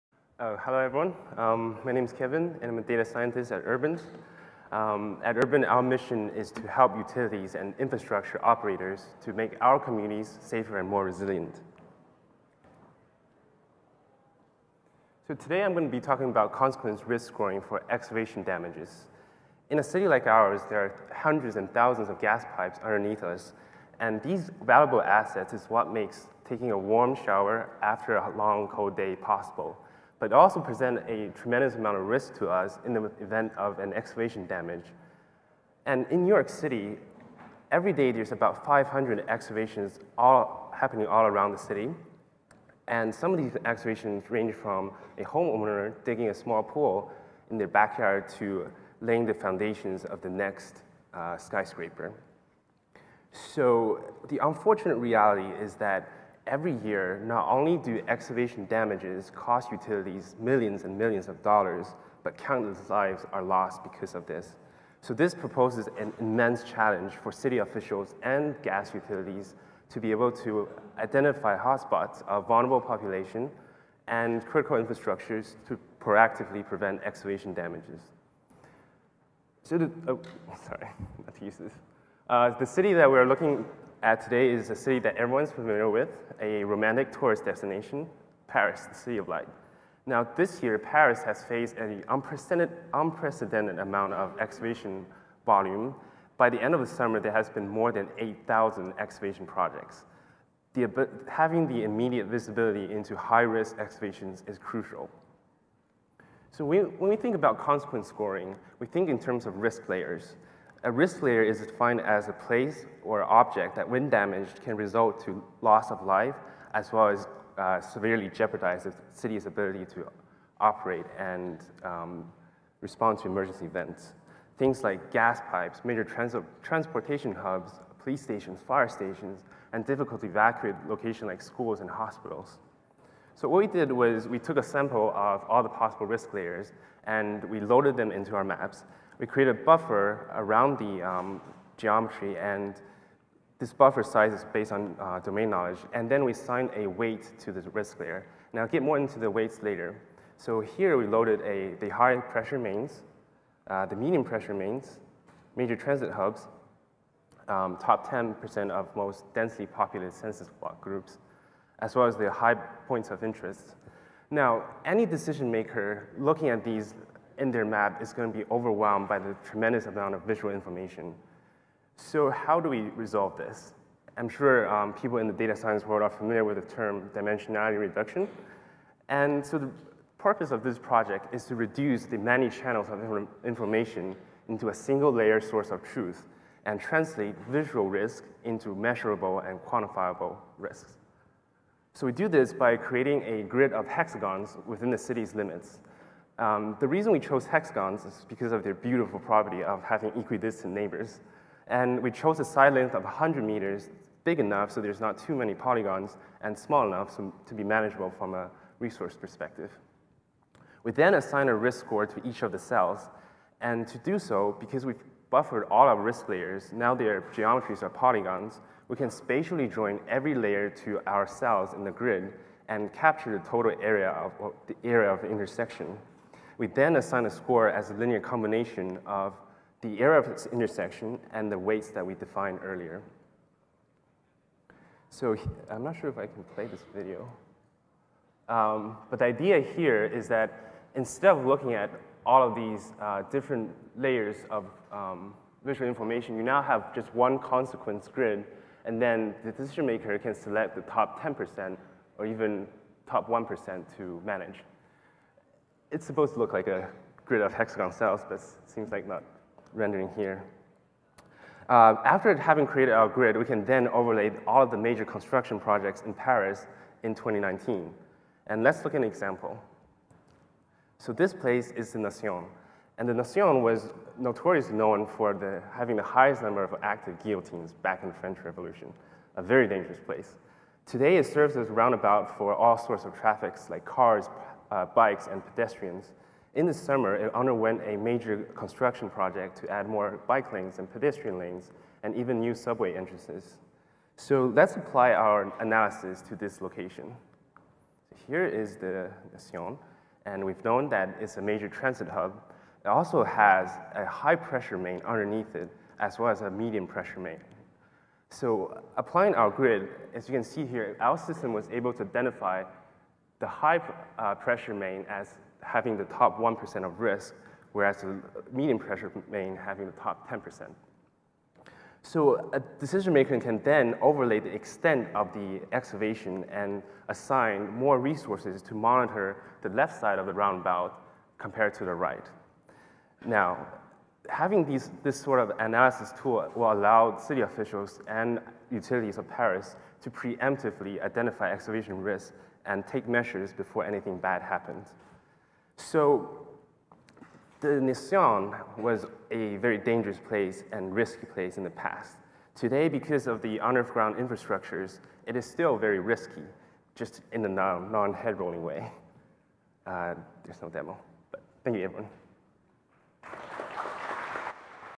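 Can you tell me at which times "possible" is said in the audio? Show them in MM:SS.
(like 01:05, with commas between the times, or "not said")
00:29, 02:15.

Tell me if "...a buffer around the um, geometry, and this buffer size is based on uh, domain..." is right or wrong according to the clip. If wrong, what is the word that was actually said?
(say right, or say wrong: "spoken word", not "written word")
right.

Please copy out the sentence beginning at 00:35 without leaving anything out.
And in New York City, every day there's about 500 excavations all happening all around the city.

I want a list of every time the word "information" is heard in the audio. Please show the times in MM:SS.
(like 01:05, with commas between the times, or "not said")
02:50, 03:03, 04:05.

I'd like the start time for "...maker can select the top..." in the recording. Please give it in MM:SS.
04:09.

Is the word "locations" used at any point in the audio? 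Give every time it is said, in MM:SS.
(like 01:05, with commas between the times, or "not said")
02:10, 04:56.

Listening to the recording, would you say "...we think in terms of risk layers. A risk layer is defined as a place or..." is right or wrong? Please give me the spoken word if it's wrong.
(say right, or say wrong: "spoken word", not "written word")
right.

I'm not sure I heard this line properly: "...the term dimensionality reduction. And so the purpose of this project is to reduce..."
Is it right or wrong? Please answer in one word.
right.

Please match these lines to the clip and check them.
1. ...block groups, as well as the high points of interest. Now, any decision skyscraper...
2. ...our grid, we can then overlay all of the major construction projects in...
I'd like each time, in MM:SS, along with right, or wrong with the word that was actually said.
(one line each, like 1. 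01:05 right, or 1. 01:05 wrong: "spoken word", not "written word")
1. 02:40 wrong: "maker", not "skyscraper"
2. 04:22 right.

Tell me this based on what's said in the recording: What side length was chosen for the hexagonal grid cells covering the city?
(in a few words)
100 meters.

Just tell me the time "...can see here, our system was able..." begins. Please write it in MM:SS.
05:10.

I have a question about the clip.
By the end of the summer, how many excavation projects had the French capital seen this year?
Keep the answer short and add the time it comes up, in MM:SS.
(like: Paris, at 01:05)
more than 8,000, at 01:37.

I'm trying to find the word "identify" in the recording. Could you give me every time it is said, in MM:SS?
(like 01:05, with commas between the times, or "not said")
01:10, 05:12, 05:41.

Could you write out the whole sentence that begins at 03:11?
So we do this by creating a grid of hexagons within the city's limits.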